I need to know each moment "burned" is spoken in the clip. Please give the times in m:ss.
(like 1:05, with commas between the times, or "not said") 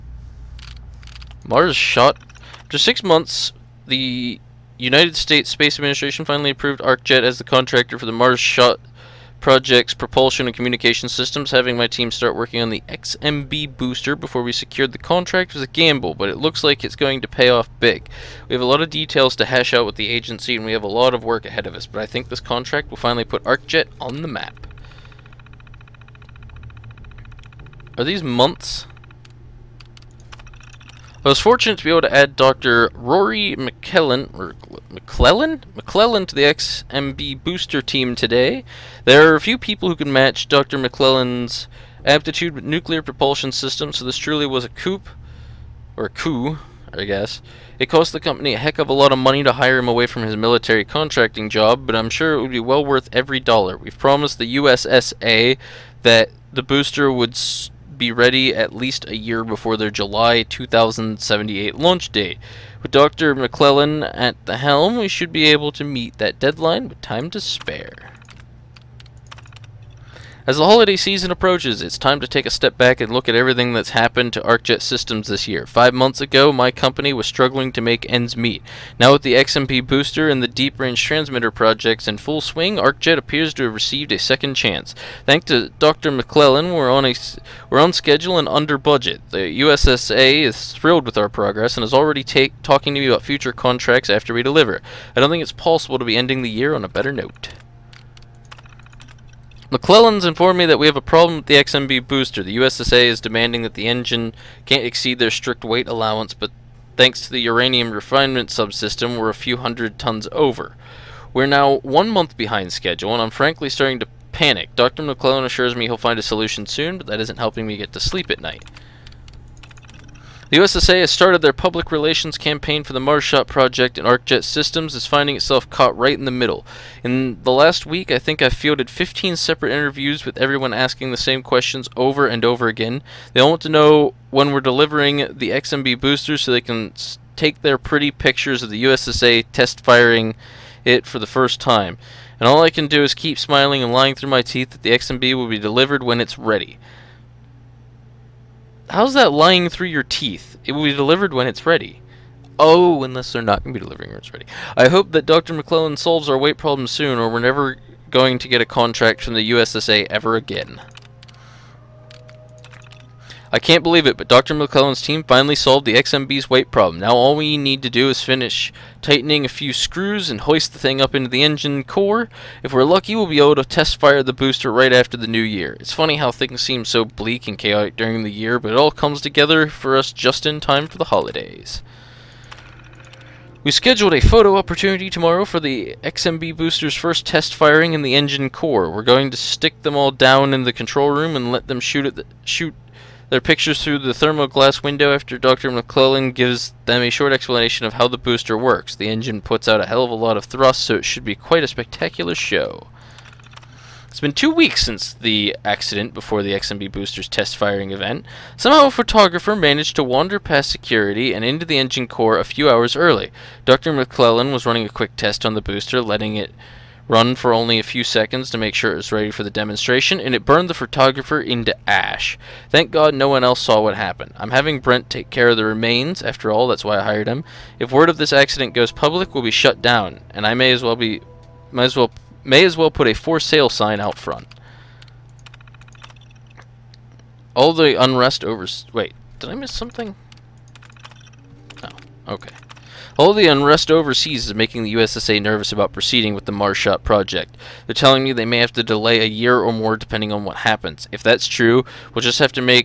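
3:40.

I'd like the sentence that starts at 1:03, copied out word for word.
McClellan at the helm, we should be able to meet that deadline with time to spare.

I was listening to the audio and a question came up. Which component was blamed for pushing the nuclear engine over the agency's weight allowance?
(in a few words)
uranium refinement subsystem.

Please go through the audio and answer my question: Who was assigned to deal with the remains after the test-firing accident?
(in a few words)
Brent.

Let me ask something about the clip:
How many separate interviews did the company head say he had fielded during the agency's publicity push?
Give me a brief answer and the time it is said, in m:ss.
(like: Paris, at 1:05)
15, at 2:08.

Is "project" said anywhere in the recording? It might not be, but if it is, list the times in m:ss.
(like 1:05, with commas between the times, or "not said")
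0:09, 1:21, 2:03, 4:07.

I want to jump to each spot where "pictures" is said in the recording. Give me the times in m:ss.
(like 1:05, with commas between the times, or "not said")
2:18, 3:13.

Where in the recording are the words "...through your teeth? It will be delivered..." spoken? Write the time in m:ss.
2:29.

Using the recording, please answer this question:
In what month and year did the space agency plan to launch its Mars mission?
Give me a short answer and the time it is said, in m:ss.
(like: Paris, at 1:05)
July 2078, at 0:59.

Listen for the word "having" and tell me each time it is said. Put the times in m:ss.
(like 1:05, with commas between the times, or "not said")
0:11, 3:44.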